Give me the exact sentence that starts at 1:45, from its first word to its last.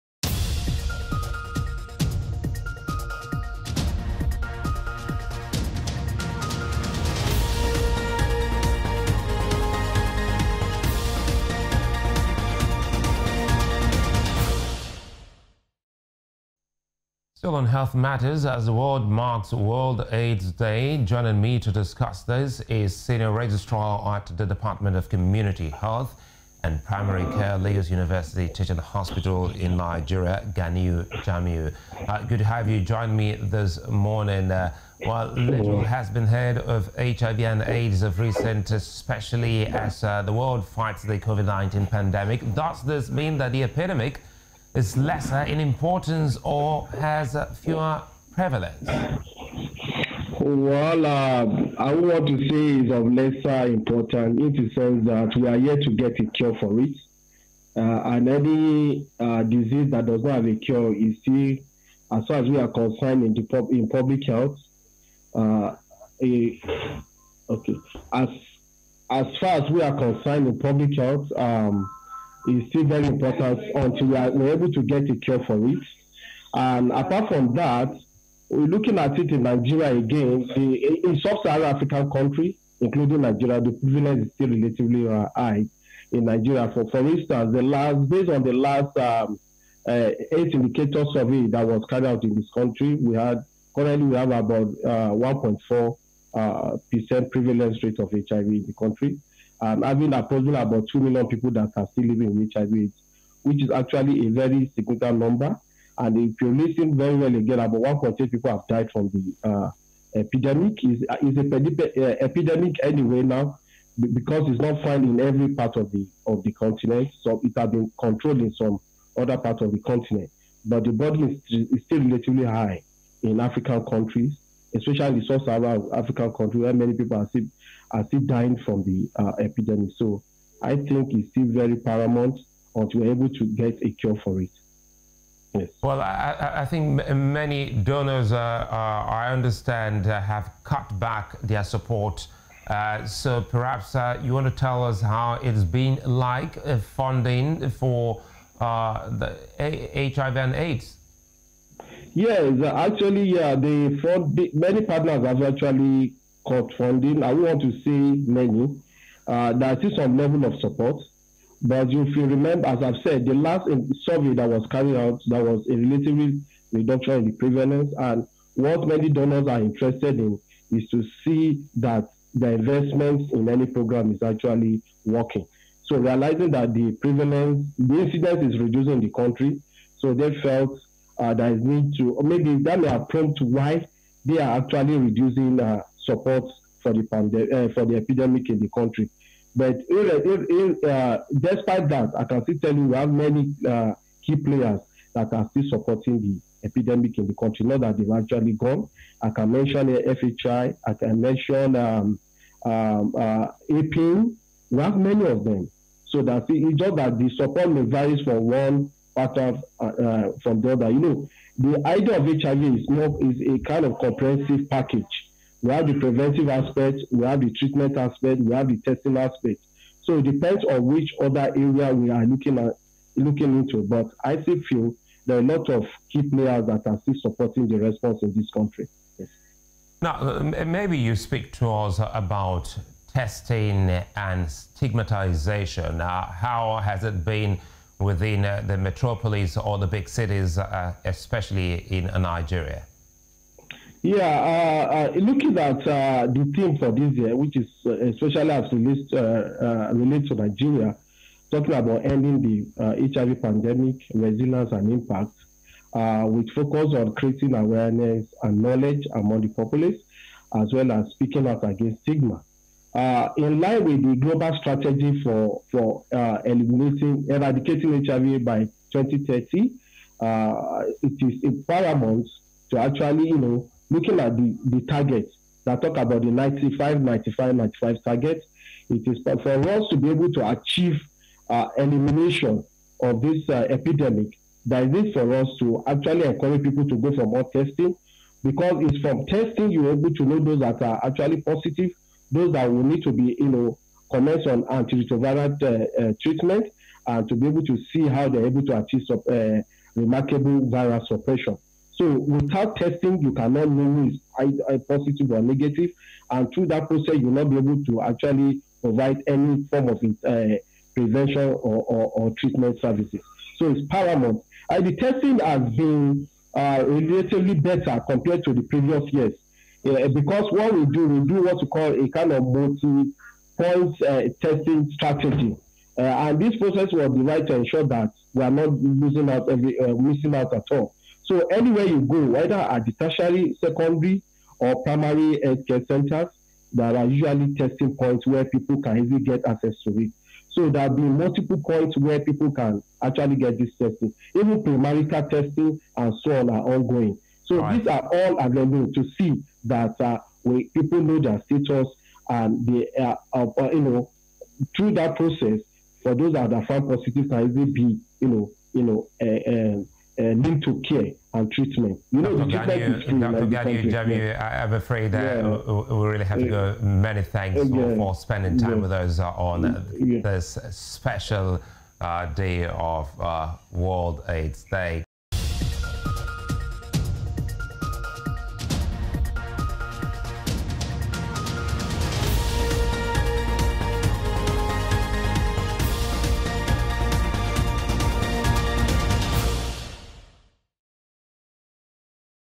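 And if you listen very well again, about 1.8 people have died from the uh, epidemic.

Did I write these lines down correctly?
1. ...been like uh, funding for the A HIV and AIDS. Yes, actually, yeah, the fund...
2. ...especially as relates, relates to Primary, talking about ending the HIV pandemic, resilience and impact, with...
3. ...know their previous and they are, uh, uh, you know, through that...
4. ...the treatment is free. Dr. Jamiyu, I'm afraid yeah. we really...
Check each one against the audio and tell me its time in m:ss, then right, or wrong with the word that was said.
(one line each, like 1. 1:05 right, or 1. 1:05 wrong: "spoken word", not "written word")
1. 2:25 right
2. 4:07 wrong: "Nigeria", not "Primary"
3. 5:51 wrong: "status", not "previous"
4. 6:02 right.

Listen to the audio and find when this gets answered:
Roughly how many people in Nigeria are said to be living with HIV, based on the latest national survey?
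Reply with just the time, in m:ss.
1:40.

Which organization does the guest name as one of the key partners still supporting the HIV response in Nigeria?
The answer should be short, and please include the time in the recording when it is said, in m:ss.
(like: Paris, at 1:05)
FHI, at 3:19.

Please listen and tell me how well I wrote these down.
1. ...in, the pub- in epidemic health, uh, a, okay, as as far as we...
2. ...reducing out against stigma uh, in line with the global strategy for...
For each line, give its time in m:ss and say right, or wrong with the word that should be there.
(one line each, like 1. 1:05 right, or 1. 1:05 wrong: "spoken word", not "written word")
1. 1:03 wrong: "public", not "epidemic"
2. 4:21 wrong: "speaking", not "reducing".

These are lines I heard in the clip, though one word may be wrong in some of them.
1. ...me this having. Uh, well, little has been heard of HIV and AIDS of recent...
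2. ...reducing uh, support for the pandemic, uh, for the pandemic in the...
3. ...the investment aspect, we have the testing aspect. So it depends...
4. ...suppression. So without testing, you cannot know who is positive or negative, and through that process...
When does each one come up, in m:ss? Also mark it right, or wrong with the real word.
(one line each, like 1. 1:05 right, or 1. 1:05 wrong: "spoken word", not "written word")
1. 0:33 wrong: "morning", not "having"
2. 3:04 wrong: "epidemic", not "pandemic"
3. 3:37 wrong: "treatment", not "investment"
4. 5:01 right.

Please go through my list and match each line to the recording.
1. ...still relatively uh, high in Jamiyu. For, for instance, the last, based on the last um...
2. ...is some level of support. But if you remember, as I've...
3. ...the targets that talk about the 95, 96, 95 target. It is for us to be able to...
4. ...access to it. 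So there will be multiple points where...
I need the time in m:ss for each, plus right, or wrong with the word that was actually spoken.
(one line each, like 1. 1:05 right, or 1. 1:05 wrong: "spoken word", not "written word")
1. 1:24 wrong: "Nigeria", not "Jamiyu"
2. 2:39 right
3. 4:34 wrong: "95", not "96"
4. 5:39 right.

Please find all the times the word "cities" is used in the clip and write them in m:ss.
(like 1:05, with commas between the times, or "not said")
4:00.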